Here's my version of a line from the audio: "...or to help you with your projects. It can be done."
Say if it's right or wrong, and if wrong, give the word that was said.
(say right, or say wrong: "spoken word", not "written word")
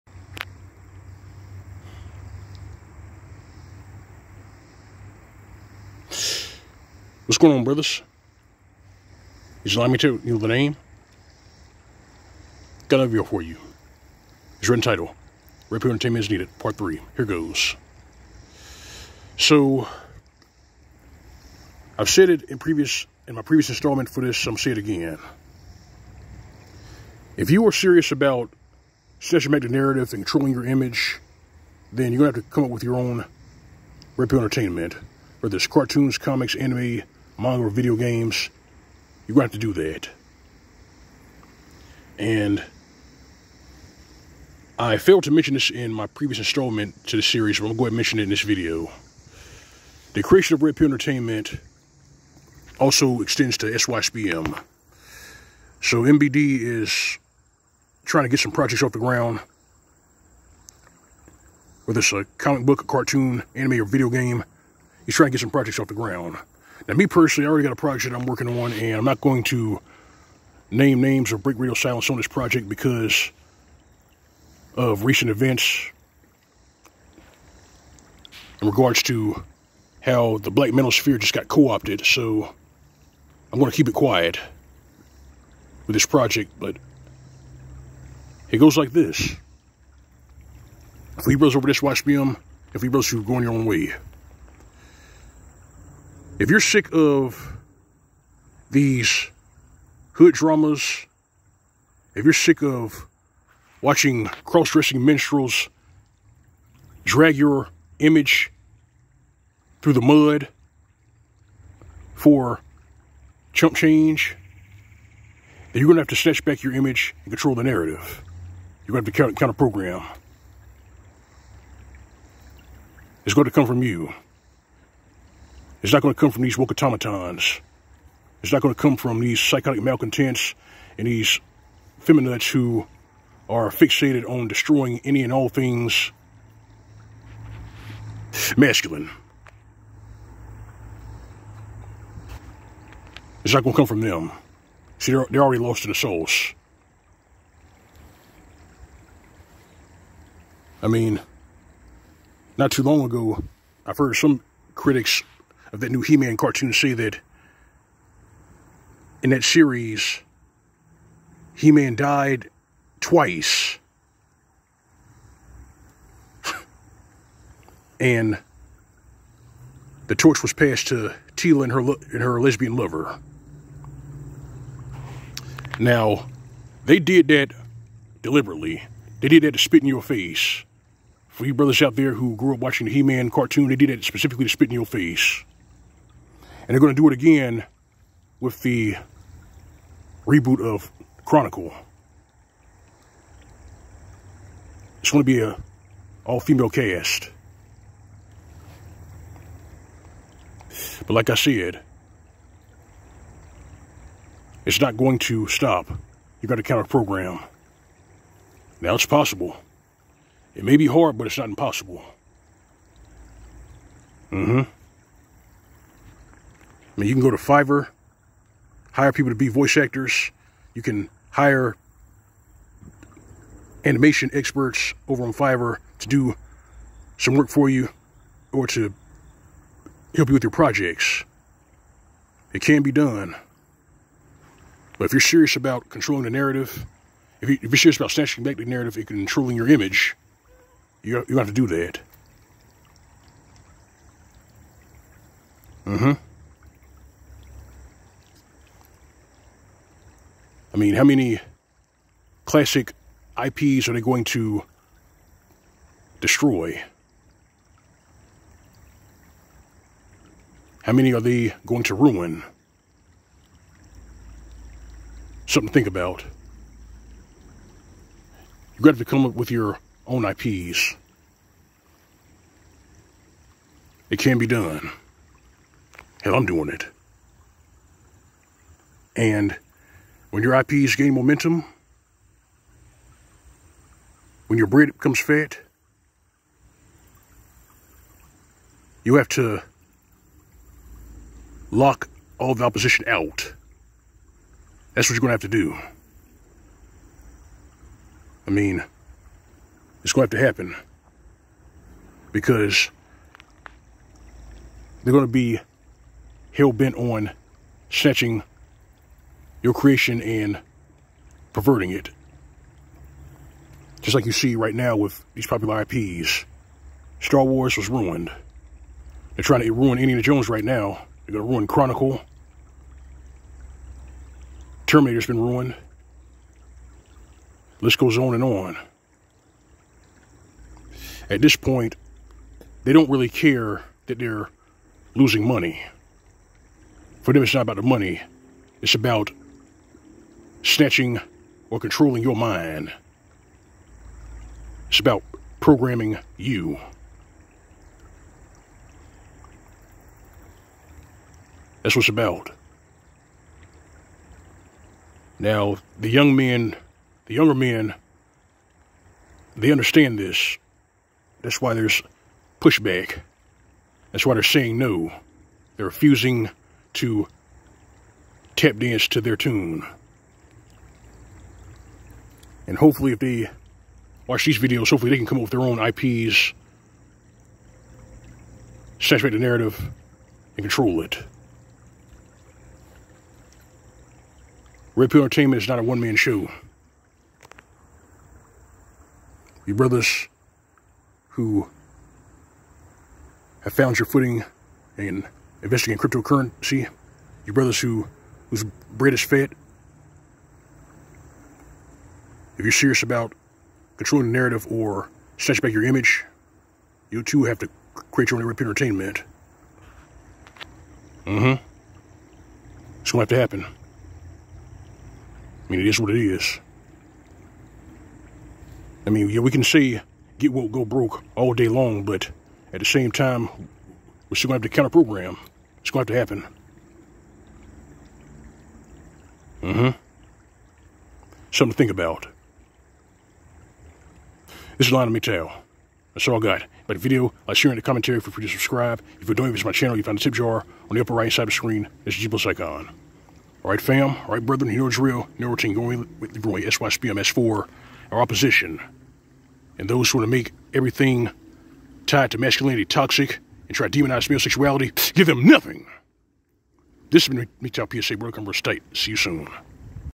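right.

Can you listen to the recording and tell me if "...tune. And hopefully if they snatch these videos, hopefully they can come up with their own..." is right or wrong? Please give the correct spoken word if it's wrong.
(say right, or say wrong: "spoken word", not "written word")
wrong: "watch", not "snatch".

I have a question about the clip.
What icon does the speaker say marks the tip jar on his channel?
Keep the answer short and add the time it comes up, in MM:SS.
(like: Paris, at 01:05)
G plus icon, at 07:22.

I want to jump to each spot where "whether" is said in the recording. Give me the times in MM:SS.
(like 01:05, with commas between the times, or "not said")
00:35, 01:01.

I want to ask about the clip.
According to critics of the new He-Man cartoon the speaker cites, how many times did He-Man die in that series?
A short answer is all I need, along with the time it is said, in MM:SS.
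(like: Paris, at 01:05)
Twice, at 02:42.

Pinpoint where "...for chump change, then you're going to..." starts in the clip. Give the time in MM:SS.
01:52.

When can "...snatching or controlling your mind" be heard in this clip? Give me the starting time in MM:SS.
05:40.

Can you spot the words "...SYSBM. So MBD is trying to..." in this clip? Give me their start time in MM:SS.
00:53.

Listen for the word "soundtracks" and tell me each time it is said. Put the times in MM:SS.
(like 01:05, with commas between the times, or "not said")
not said.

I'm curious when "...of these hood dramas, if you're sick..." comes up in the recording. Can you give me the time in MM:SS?
01:36.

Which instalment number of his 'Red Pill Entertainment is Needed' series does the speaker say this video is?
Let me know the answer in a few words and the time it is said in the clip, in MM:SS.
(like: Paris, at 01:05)
3, at 00:16.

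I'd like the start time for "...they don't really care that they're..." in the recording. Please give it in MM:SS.
05:32.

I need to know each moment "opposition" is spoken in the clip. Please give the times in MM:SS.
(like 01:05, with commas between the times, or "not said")
04:52, 07:28.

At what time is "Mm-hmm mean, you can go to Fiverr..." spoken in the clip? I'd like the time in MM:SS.
03:34.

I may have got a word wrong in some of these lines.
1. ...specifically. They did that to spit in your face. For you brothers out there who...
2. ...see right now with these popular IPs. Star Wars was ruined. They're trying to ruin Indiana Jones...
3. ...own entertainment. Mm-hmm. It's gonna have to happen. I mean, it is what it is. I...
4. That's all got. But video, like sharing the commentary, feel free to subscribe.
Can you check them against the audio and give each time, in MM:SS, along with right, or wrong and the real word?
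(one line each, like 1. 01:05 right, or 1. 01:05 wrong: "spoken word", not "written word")
1. 02:58 wrong: "deliberately", not "specifically"
2. 05:14 right
3. 06:48 right
4. 07:16 right.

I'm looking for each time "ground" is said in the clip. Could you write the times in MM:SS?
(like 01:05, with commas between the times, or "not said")
00:58, 01:05.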